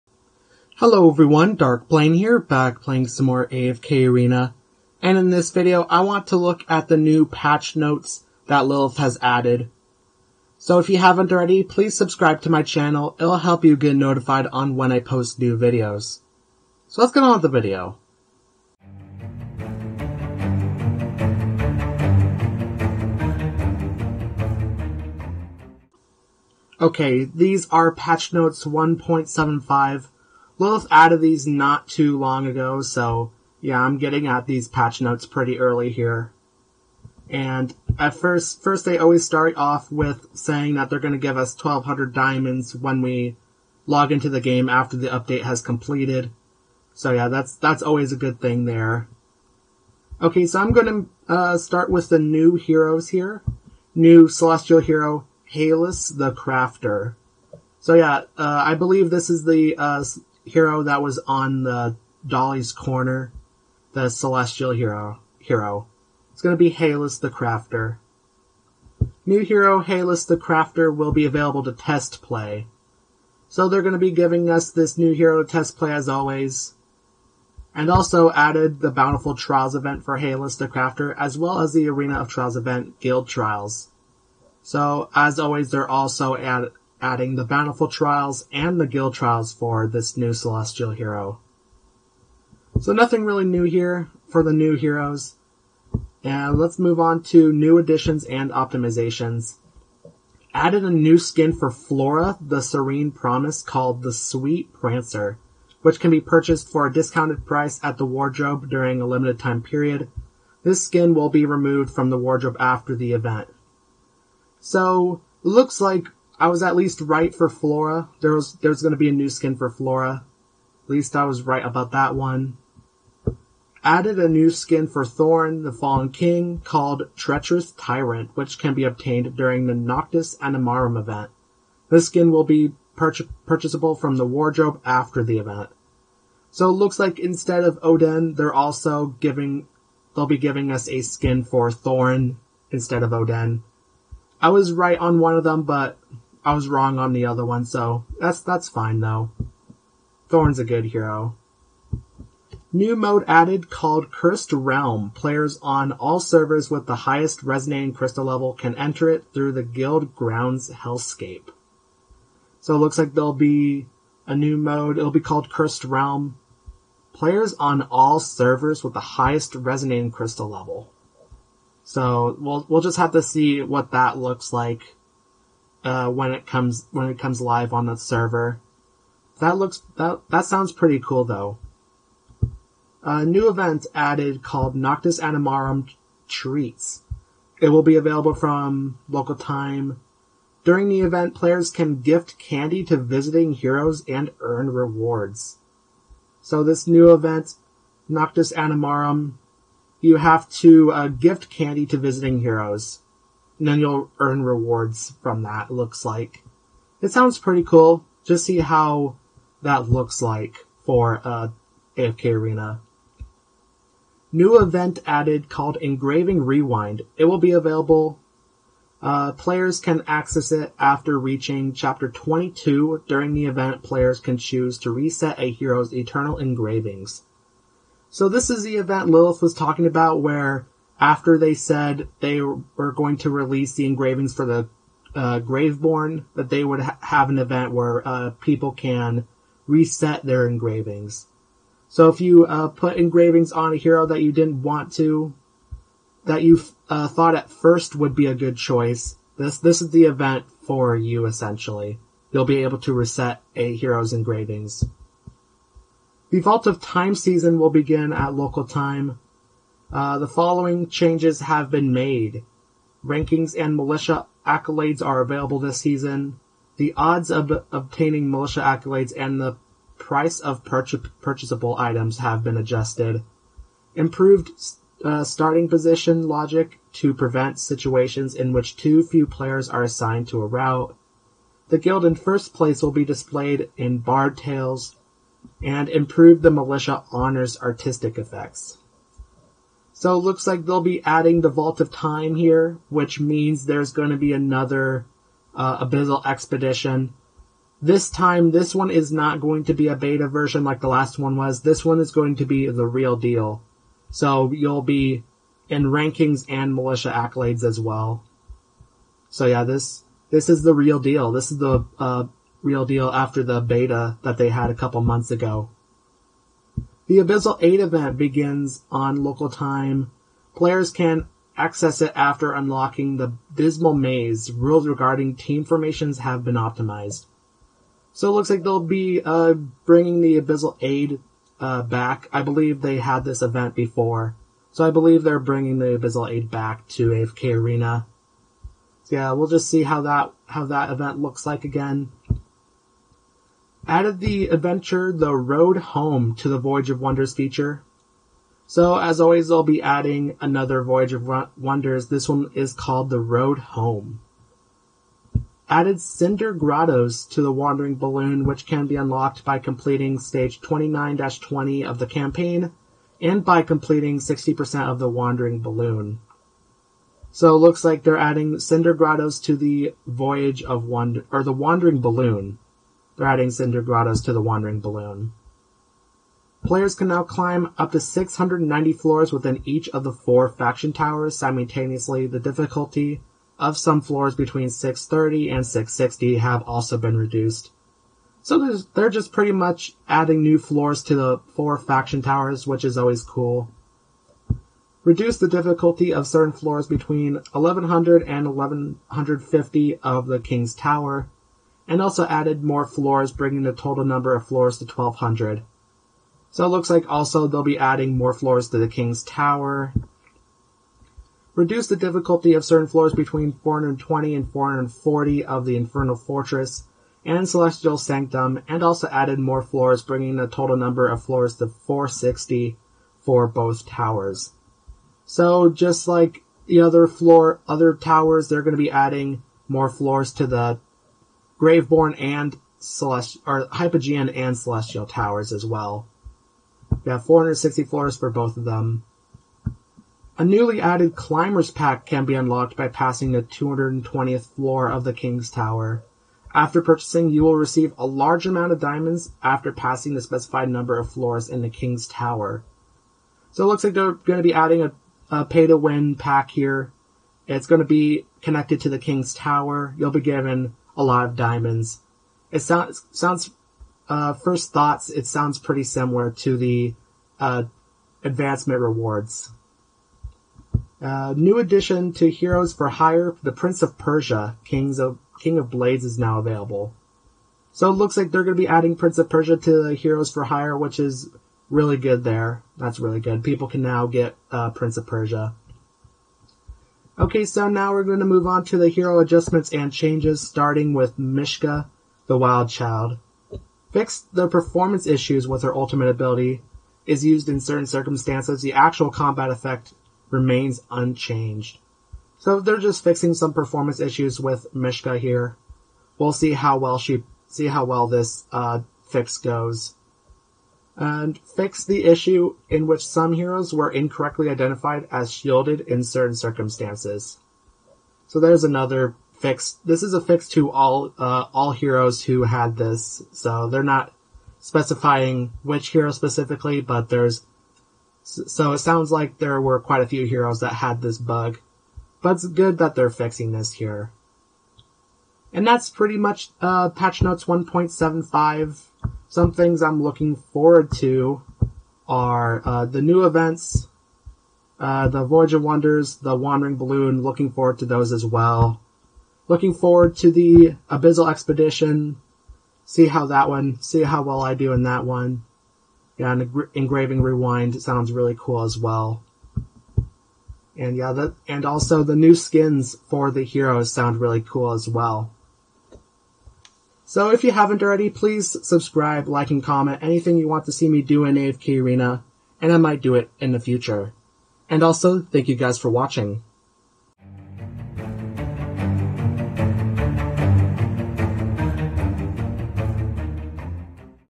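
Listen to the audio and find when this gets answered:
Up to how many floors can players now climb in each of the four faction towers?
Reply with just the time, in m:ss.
6:17.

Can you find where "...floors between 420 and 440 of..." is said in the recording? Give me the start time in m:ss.
6:52.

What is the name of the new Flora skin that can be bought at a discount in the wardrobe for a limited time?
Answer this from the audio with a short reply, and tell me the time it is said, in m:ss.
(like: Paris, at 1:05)
Sweet Prancer, at 1:44.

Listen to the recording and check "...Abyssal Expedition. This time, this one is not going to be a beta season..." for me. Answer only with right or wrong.
wrong.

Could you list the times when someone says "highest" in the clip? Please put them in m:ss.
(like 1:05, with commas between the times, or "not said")
2:36, 2:49.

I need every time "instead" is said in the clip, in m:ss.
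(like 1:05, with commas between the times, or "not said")
2:17, 2:22.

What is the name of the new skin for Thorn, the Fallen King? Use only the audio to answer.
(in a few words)
Treacherous Tyrant.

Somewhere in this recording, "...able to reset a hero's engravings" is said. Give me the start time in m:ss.
4:12.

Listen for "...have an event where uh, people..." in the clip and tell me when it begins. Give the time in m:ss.
3:57.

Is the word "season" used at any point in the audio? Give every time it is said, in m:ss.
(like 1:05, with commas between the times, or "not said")
4:17, 4:25.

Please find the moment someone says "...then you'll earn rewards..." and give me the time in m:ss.
3:23.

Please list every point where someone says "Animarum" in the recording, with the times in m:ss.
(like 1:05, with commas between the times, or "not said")
2:10, 3:05, 3:18.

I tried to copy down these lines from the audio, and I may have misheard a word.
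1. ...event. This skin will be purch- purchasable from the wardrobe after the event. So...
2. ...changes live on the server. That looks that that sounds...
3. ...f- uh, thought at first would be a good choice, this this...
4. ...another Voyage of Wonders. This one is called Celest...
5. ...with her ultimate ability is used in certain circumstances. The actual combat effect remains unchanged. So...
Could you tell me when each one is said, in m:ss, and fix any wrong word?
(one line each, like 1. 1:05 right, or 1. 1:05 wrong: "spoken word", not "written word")
1. 2:10 right
2. 2:57 wrong: "comes", not "changes"
3. 4:06 right
4. 5:50 wrong: "The", not "Celest"
5. 8:15 right.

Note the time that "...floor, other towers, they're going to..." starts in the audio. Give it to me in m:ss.
7:07.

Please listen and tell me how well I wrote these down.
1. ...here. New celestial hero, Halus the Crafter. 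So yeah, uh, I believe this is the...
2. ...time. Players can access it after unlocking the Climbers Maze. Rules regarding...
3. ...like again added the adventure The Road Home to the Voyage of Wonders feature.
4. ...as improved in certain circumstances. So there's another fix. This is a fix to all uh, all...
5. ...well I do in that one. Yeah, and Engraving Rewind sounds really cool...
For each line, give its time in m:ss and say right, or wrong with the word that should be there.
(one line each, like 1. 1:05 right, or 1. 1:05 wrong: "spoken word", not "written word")
1. 0:53 right
2. 5:19 wrong: "Dismal", not "Climbers"
3. 5:41 right
4. 8:35 wrong: "shielded", not "improved"
5. 9:14 right.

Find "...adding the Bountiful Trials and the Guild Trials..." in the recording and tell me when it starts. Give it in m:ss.
1:27.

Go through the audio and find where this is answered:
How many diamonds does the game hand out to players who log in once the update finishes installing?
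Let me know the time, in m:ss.
0:41.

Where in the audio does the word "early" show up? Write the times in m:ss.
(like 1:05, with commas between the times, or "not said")
0:35.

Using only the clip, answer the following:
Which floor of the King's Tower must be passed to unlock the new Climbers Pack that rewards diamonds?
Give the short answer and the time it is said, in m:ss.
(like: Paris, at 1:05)
220th, at 7:23.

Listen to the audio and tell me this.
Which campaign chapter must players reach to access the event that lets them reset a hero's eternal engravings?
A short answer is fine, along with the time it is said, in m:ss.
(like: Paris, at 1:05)
Chapter 22, at 3:41.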